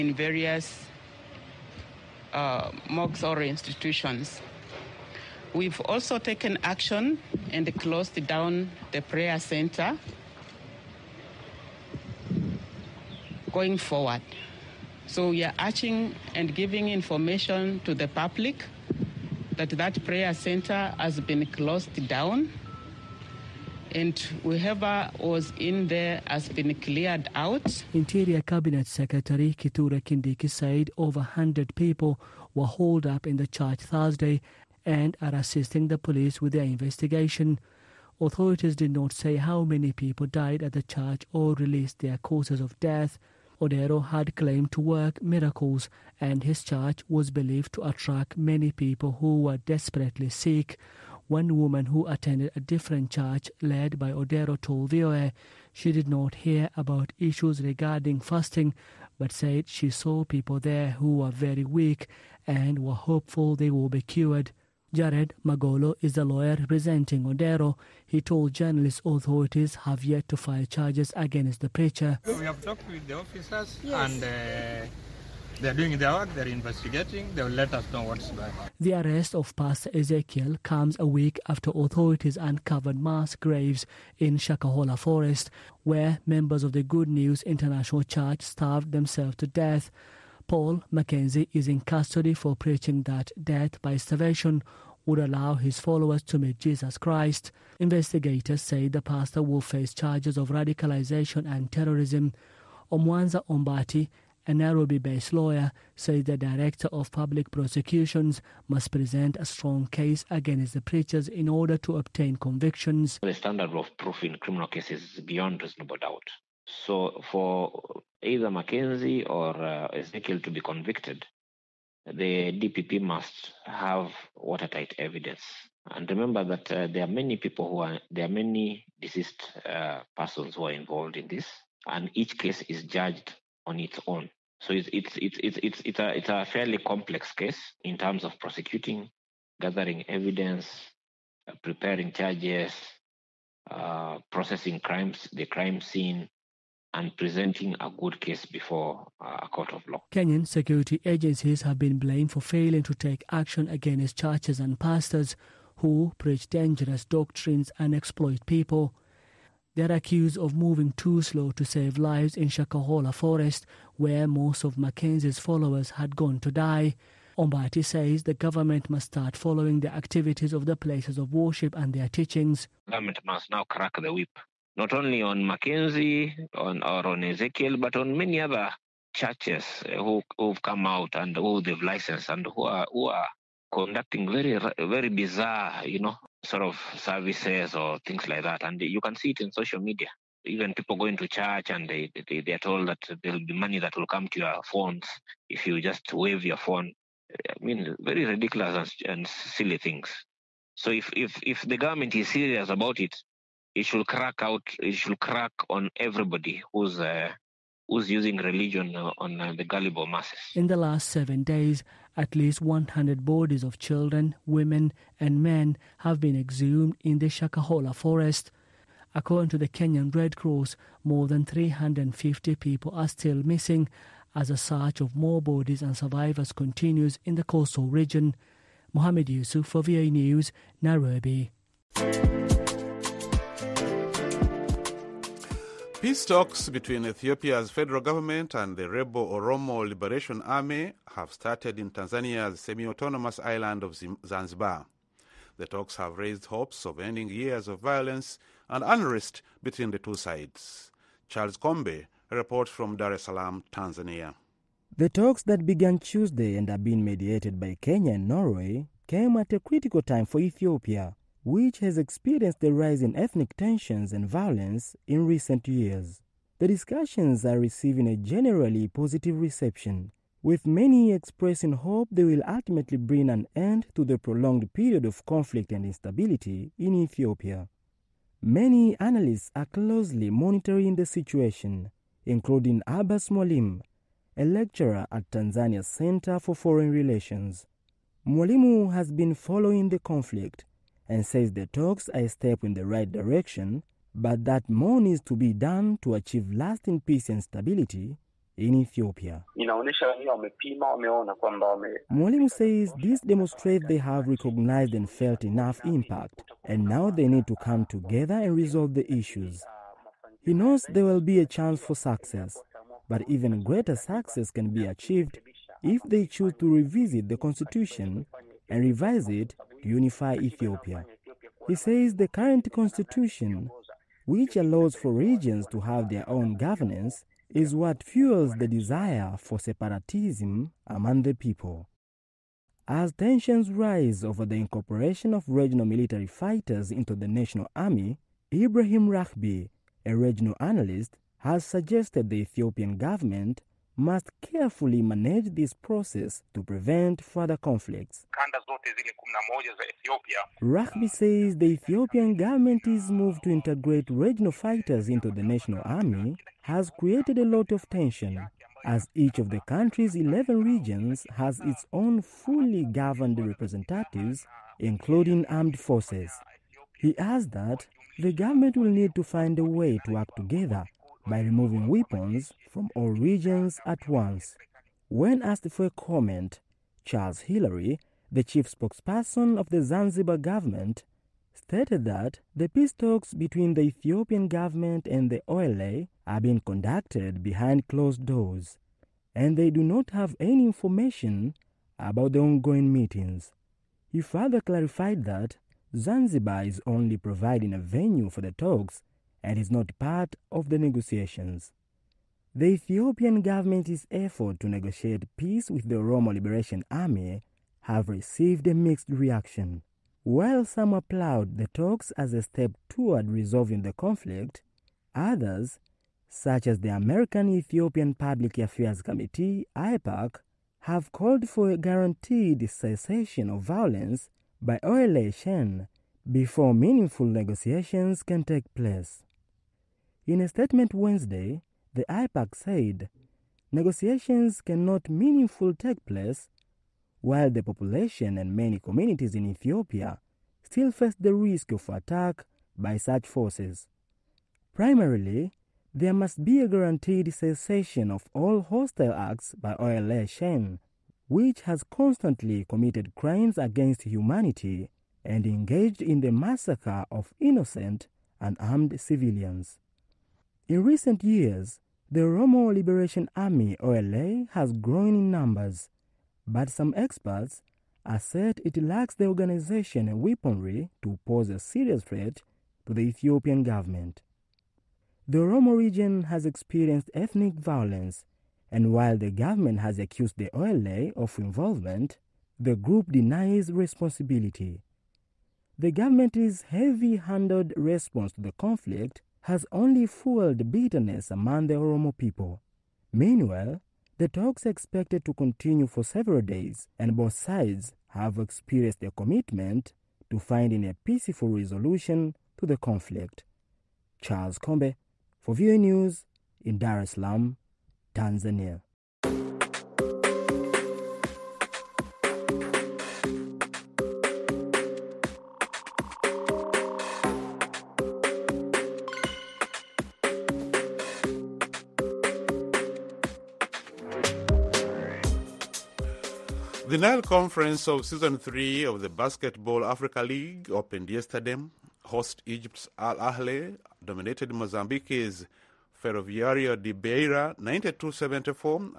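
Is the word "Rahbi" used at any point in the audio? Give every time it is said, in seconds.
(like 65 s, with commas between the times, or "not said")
339 s, 350 s.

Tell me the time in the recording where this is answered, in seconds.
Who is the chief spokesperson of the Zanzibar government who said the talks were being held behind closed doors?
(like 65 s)
377 s.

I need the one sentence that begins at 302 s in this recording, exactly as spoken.
Mwalimu says this demonstrates they have recognized and felt enough impact, and now they need to come together and resolve the issues.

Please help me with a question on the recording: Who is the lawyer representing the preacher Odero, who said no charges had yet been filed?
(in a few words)
Jared Magolo.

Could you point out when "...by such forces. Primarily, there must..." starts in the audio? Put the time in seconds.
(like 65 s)
442 s.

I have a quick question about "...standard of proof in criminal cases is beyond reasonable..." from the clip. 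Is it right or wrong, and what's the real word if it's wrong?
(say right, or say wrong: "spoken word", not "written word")
right.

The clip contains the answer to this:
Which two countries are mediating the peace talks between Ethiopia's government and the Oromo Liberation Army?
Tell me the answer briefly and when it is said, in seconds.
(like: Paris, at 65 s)
Kenya and Norway, at 257 s.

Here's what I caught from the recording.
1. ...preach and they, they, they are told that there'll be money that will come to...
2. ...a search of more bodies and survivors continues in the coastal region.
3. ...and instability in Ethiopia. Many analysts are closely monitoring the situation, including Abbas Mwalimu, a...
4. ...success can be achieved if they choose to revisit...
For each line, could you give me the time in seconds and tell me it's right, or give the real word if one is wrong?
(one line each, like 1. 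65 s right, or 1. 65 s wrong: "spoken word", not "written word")
1. 191 s wrong: "church", not "preach"
2. 224 s right
3. 275 s right
4. 313 s right.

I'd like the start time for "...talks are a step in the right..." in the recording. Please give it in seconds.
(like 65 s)
291 s.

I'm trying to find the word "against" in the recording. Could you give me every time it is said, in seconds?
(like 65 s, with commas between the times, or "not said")
71 s, 110 s, 153 s, 453 s.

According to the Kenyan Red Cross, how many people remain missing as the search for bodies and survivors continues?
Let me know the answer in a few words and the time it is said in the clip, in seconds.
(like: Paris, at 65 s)
More than 350, at 221 s.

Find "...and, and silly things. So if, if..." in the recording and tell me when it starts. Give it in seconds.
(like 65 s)
198 s.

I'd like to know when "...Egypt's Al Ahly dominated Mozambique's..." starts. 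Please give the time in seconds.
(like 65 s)
532 s.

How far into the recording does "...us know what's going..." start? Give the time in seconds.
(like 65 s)
77 s.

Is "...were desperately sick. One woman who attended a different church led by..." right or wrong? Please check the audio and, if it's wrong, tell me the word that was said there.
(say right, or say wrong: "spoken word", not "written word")
right.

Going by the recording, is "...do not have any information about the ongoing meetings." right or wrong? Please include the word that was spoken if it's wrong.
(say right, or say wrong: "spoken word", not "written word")
right.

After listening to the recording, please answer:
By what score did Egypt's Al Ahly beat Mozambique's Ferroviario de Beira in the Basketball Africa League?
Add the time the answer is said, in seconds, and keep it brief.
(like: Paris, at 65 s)
92-74, at 537 s.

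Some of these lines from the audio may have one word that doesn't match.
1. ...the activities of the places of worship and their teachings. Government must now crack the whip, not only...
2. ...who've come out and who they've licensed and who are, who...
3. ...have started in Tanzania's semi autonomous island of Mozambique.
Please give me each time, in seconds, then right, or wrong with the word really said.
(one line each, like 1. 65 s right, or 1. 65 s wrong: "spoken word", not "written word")
1. 169 s right
2. 180 s right
3. 241 s wrong: "Zanzibar", not "Mozambique".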